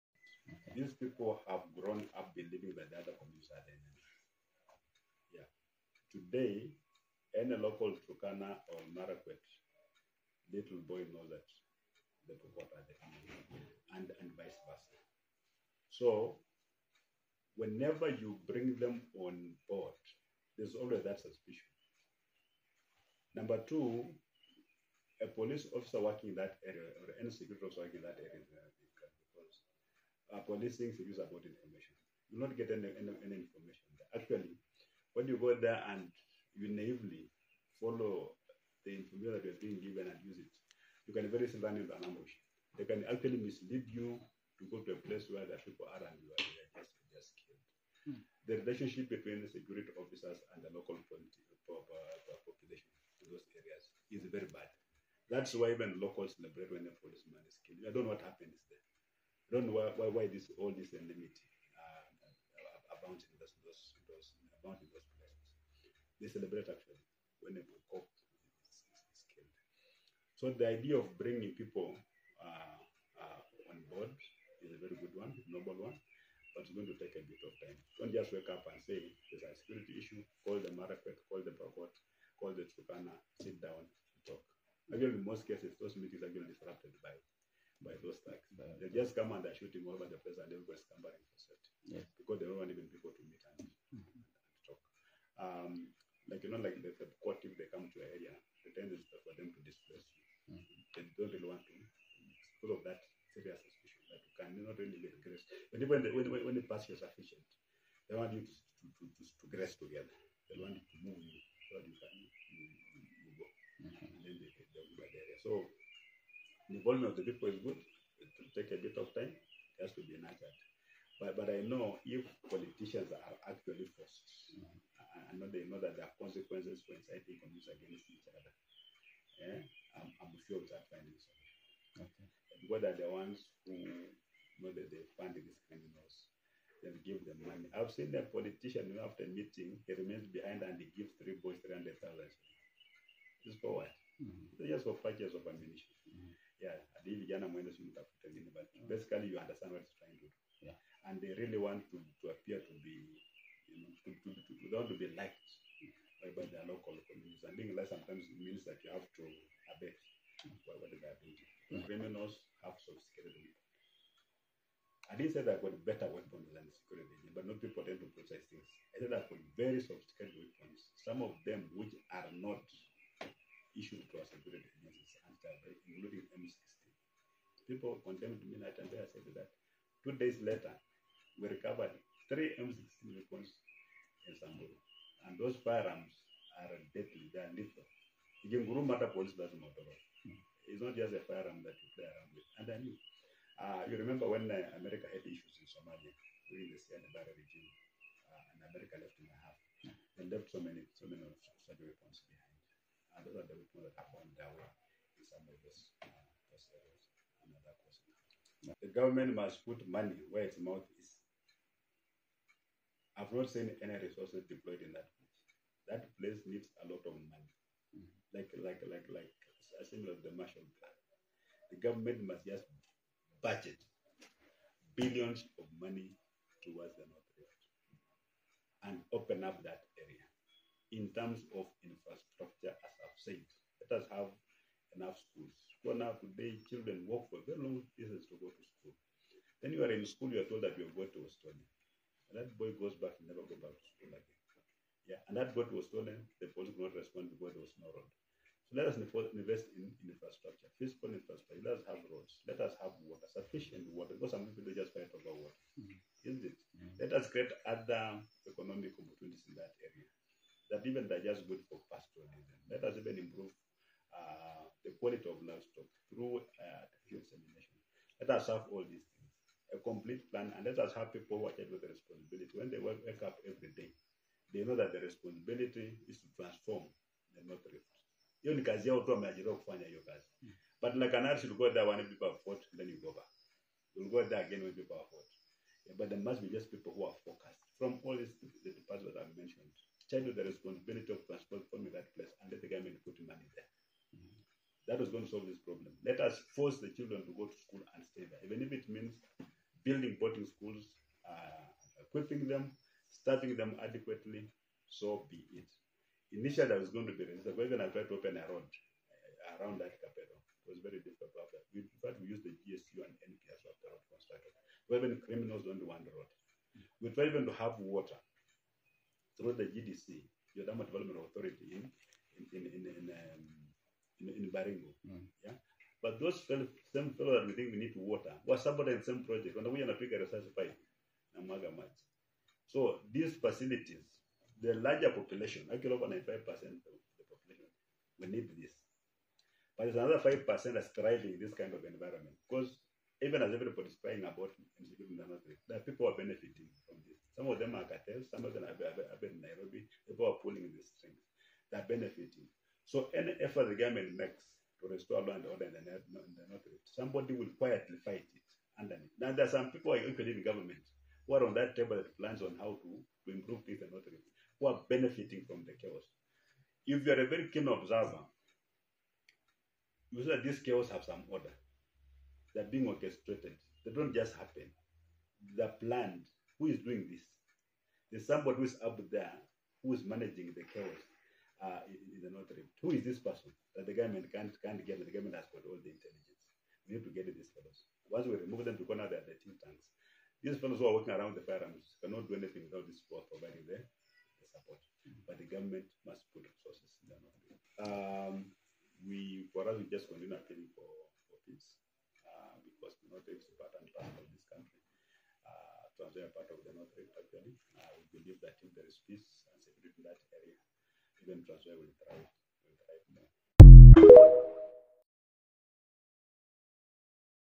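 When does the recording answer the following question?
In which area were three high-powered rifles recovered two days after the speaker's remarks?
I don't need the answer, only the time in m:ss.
3:04.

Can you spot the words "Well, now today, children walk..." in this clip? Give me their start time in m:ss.
3:55.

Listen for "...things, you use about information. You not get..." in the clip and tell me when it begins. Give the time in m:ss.
0:30.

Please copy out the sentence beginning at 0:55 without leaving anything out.
That's why even locals celebrate when a policeman is killed.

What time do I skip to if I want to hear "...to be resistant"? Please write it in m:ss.
5:07.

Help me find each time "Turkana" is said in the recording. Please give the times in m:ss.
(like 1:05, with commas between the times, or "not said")
0:08, 1:22.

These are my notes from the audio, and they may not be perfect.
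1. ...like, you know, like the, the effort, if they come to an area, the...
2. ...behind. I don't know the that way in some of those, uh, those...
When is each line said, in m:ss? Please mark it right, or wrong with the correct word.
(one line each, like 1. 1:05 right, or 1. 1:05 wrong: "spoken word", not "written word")
1. 1:36 wrong: "court", not "effort"
2. 3:22 right.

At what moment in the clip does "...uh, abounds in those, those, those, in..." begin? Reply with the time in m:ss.
1:01.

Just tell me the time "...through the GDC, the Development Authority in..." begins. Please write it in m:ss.
5:19.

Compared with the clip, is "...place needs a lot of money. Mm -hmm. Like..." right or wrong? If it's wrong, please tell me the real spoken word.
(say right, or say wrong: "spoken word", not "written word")
right.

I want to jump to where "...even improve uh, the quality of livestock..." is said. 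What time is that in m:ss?
4:22.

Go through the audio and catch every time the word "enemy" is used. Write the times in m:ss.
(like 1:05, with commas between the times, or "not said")
0:03, 0:13.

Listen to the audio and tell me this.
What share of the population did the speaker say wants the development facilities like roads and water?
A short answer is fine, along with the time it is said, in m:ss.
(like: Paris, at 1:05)
over 95%, at 5:35.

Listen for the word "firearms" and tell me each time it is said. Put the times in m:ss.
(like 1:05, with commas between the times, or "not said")
3:05, 3:11, 6:31.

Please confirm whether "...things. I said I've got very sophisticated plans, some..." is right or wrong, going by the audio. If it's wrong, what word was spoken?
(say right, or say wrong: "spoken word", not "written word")
wrong: "weapons", not "plans".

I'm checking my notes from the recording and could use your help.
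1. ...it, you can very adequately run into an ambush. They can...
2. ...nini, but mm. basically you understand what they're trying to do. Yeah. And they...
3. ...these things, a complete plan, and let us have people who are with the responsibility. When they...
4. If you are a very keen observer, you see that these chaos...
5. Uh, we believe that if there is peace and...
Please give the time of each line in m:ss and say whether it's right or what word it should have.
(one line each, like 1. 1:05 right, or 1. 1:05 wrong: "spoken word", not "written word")
1. 0:40 wrong: "easily", not "adequately"
2. 2:28 right
3. 4:28 right
4. 6:06 right
5. 6:47 right.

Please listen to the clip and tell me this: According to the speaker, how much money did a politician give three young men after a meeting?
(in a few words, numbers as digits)
300,000.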